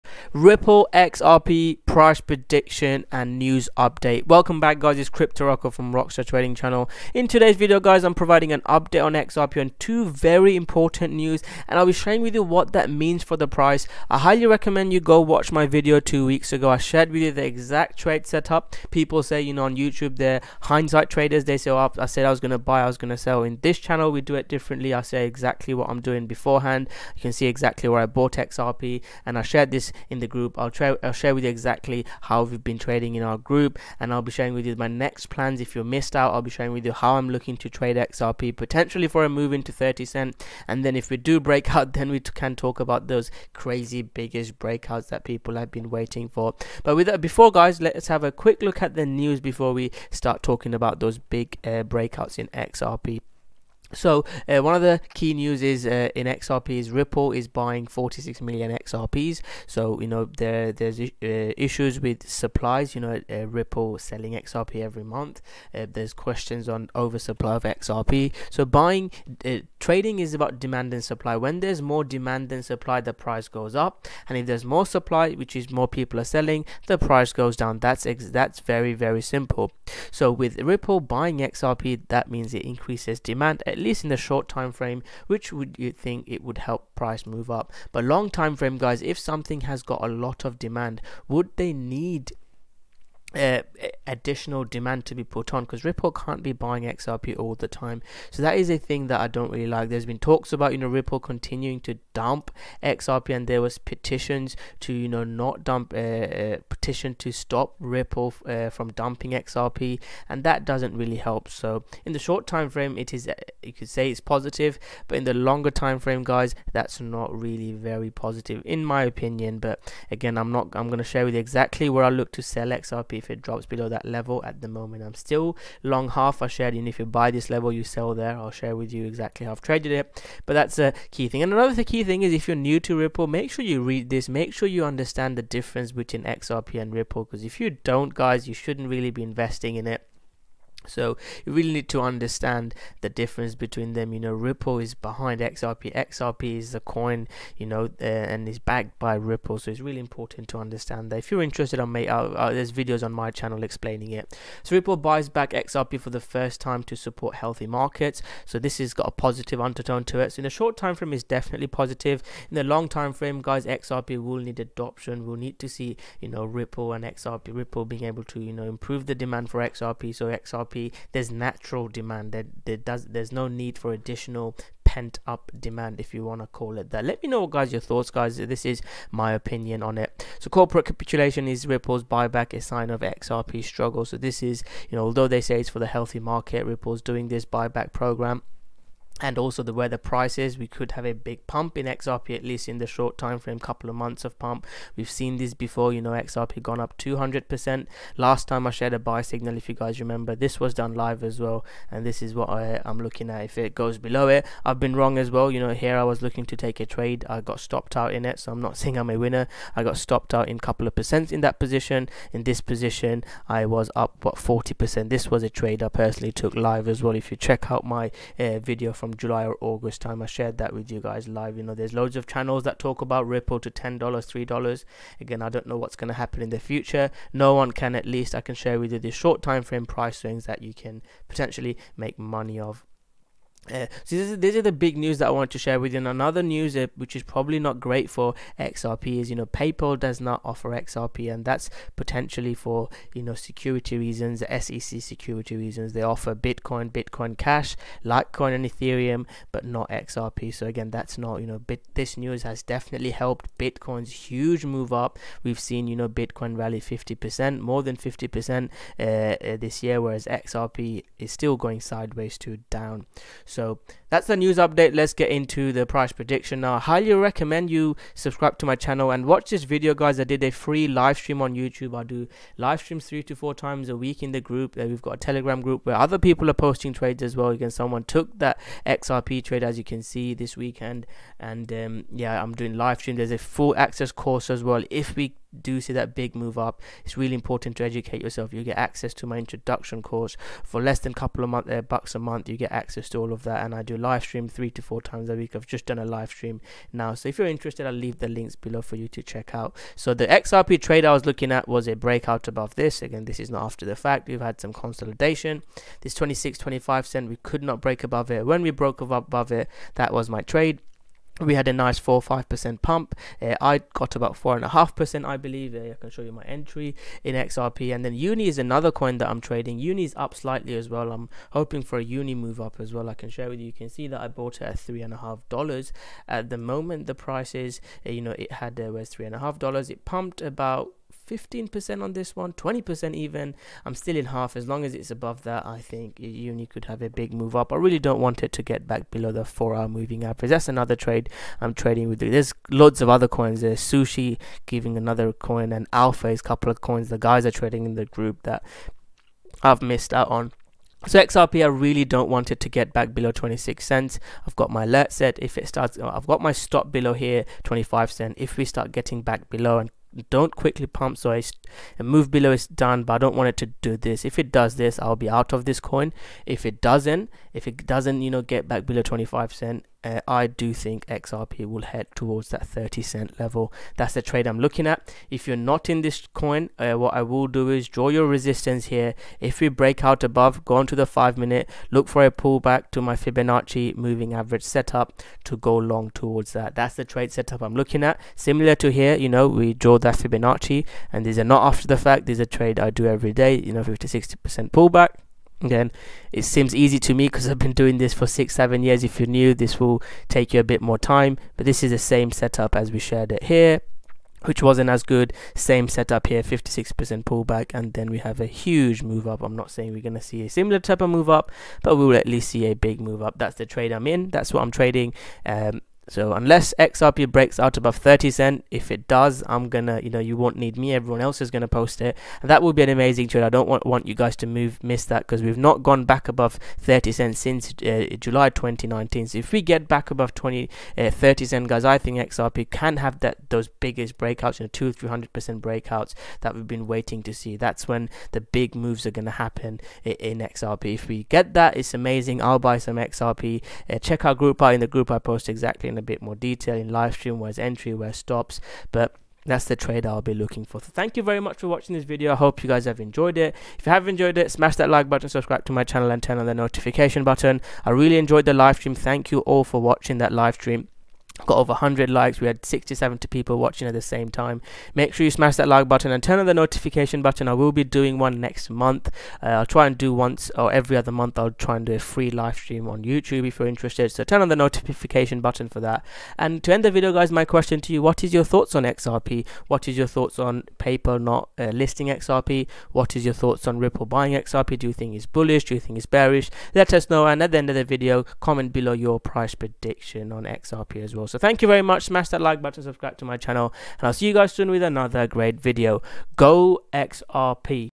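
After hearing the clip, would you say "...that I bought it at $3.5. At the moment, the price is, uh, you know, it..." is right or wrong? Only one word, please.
right.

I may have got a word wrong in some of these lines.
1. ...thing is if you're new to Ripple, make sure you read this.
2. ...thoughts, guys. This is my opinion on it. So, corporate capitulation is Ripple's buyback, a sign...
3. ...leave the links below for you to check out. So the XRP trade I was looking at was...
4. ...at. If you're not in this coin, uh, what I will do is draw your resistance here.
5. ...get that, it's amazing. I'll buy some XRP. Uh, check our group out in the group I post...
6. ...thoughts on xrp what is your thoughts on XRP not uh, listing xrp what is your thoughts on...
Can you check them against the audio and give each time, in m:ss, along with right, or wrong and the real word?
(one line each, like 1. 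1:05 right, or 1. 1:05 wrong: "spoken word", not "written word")
1. 2:12 right
2. 2:57 right
3. 4:57 right
4. 6:14 right
5. 7:21 right
6. 7:58 wrong: "PayPal", not "XRP".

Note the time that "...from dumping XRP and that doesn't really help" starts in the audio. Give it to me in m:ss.
1:48.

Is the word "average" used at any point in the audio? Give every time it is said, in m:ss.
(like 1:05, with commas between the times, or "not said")
5:40, 6:24.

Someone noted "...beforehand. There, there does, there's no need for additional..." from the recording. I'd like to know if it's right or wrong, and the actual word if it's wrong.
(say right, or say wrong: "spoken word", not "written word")
wrong: "demand", not "beforehand".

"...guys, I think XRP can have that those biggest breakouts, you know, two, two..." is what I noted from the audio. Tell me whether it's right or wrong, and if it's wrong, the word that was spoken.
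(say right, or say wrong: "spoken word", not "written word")
wrong: "three", not "two".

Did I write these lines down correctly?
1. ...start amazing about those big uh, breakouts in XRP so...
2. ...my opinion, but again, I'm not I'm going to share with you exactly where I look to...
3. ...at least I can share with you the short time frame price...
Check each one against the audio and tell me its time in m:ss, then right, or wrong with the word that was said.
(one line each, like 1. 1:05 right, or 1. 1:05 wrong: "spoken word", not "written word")
1. 0:50 wrong: "talking", not "amazing"
2. 1:58 right
3. 3:47 right.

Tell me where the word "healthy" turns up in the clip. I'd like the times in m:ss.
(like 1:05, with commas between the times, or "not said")
2:37, 3:05.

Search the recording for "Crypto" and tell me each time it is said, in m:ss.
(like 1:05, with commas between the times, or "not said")
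0:05.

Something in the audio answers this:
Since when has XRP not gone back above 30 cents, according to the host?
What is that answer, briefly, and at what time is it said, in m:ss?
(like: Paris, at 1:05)
July 2019, at 7:08.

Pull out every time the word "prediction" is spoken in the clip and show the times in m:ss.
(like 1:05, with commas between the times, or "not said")
0:02, 4:26, 8:09.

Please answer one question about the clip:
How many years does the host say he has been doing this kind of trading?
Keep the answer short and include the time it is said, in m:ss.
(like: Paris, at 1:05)
six, seven years, at 6:38.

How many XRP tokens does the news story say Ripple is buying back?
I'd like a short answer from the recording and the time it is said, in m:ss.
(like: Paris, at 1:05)
46 million, at 0:57.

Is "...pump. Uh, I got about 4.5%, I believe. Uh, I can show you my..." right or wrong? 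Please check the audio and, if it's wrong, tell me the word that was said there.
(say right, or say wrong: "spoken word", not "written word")
right.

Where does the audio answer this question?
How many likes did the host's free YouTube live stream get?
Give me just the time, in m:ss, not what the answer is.
7:41.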